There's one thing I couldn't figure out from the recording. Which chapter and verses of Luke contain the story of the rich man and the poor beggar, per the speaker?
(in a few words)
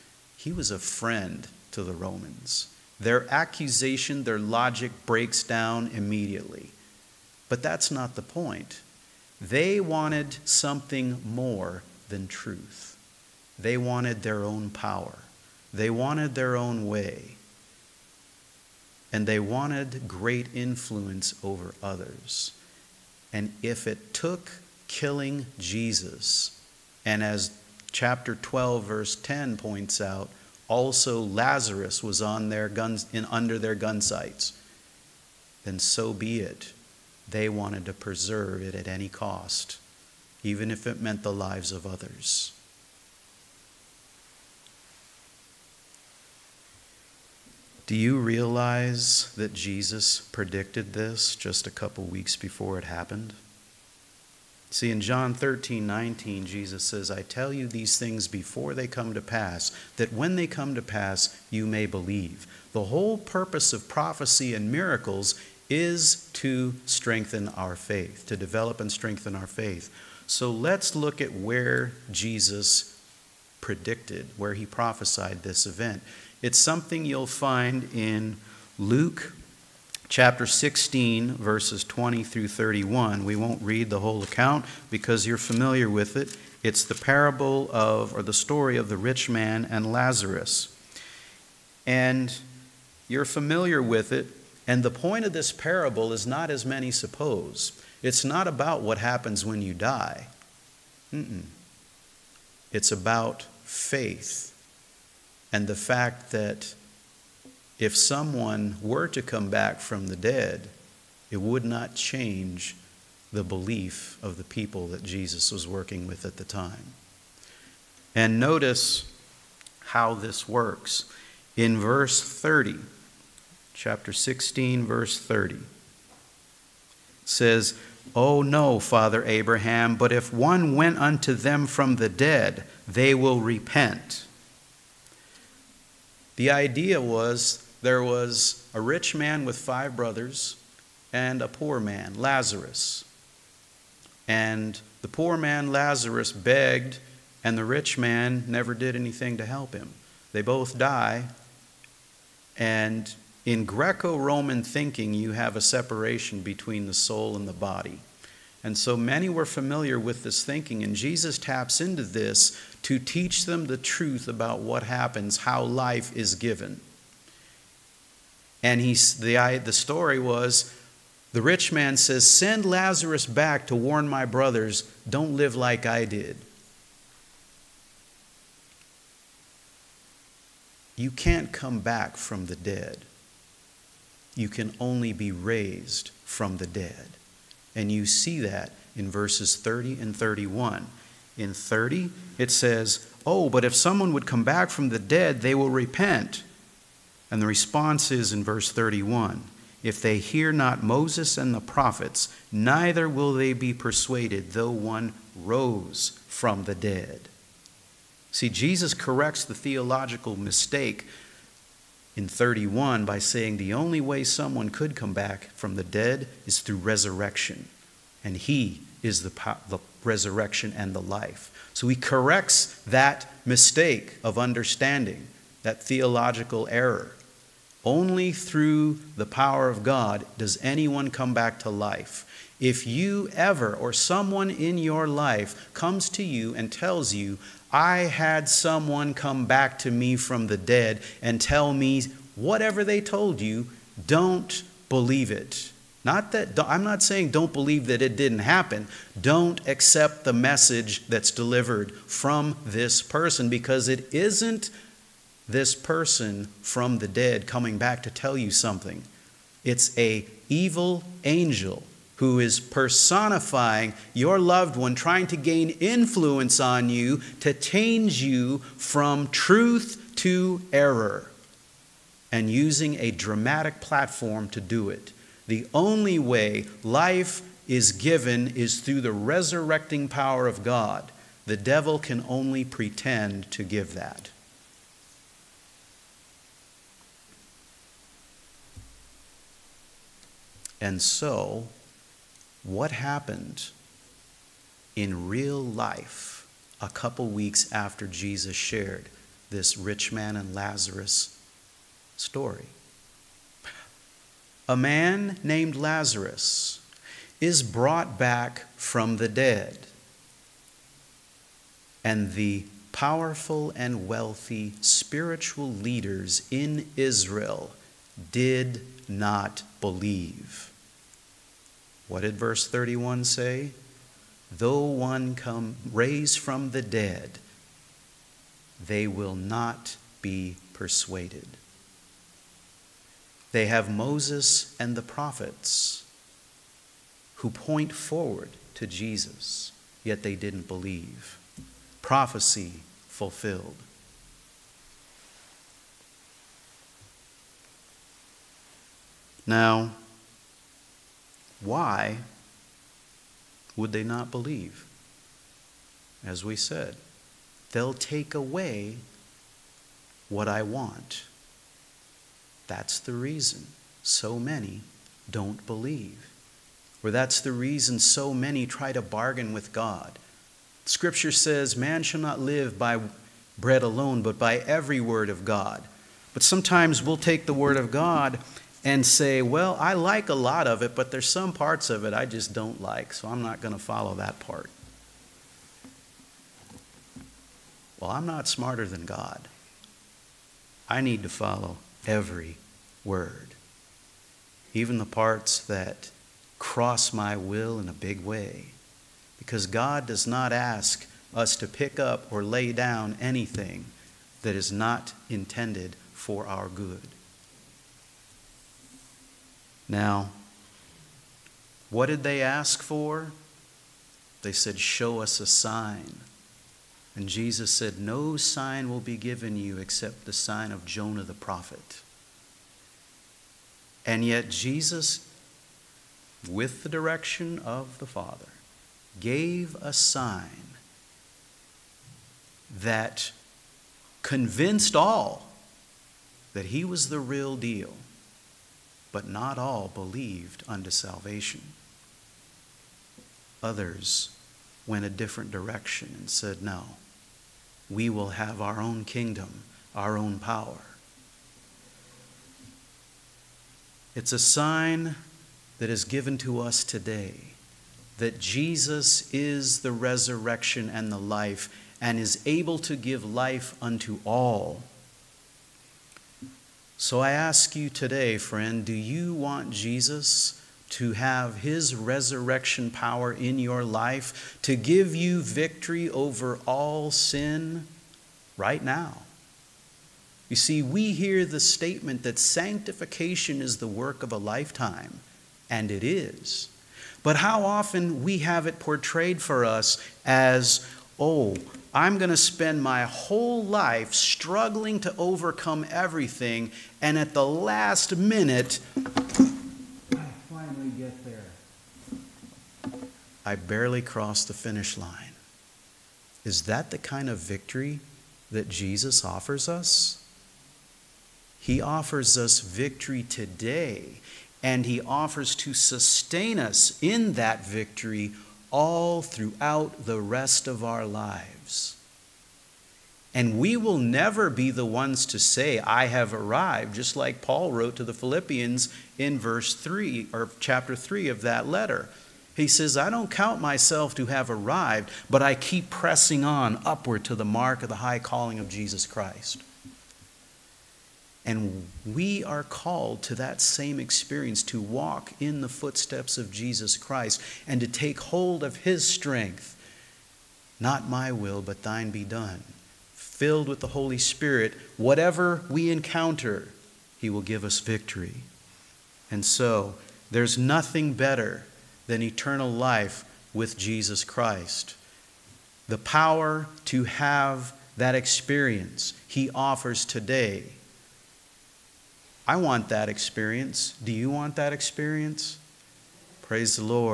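Luke 16:20-31.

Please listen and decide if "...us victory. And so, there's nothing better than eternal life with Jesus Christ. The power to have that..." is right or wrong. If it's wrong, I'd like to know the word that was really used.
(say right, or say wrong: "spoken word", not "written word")
right.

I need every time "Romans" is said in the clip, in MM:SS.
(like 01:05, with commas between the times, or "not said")
00:01, 02:34.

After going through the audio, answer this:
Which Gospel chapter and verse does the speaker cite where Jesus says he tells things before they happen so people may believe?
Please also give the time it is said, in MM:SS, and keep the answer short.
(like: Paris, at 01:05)
John 13:19, at 00:54.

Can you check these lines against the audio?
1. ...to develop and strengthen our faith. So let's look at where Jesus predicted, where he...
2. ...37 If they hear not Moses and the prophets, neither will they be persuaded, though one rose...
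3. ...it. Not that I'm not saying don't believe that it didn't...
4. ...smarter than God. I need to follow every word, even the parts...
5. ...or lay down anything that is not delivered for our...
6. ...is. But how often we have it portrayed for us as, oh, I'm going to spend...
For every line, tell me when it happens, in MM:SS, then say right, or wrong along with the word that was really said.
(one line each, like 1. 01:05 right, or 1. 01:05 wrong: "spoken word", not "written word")
1. 01:08 right
2. 03:18 wrong: "31", not "37"
3. 04:05 right
4. 06:28 right
5. 06:42 wrong: "intended", not "delivered"
6. 08:06 right.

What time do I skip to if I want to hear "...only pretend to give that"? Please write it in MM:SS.
04:42.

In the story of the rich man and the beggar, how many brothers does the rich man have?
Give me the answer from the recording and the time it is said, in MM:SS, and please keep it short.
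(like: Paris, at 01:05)
5, at 02:19.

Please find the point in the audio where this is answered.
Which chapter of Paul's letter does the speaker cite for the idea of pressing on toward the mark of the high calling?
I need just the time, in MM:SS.
08:50.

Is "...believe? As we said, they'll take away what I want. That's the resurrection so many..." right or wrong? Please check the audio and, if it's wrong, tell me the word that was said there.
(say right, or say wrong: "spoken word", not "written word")
wrong: "reason", not "resurrection".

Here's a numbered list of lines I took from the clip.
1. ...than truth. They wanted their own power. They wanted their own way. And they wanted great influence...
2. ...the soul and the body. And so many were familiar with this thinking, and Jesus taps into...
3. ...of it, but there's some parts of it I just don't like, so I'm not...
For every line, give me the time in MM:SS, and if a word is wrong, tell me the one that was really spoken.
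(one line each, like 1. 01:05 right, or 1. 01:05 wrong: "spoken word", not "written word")
1. 00:12 right
2. 02:36 right
3. 06:20 right.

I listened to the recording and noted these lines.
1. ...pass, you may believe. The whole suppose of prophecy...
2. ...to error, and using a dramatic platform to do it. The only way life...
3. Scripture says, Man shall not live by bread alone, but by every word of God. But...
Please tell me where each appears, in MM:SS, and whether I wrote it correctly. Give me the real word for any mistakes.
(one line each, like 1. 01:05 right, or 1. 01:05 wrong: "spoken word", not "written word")
1. 01:00 wrong: "purpose", not "suppose"
2. 04:30 right
3. 06:10 right.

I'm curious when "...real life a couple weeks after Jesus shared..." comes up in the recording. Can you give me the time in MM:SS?
04:55.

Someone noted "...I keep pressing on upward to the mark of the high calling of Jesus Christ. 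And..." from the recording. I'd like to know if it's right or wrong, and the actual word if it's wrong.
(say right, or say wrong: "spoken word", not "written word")
right.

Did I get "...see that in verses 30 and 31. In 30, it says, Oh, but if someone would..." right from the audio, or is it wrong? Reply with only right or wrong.
right.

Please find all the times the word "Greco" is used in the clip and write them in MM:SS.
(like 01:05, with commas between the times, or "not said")
02:33.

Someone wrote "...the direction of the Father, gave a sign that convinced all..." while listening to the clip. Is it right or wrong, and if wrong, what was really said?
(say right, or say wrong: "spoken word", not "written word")
right.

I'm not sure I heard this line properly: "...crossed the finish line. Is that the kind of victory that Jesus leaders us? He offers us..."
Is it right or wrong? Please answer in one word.
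wrong.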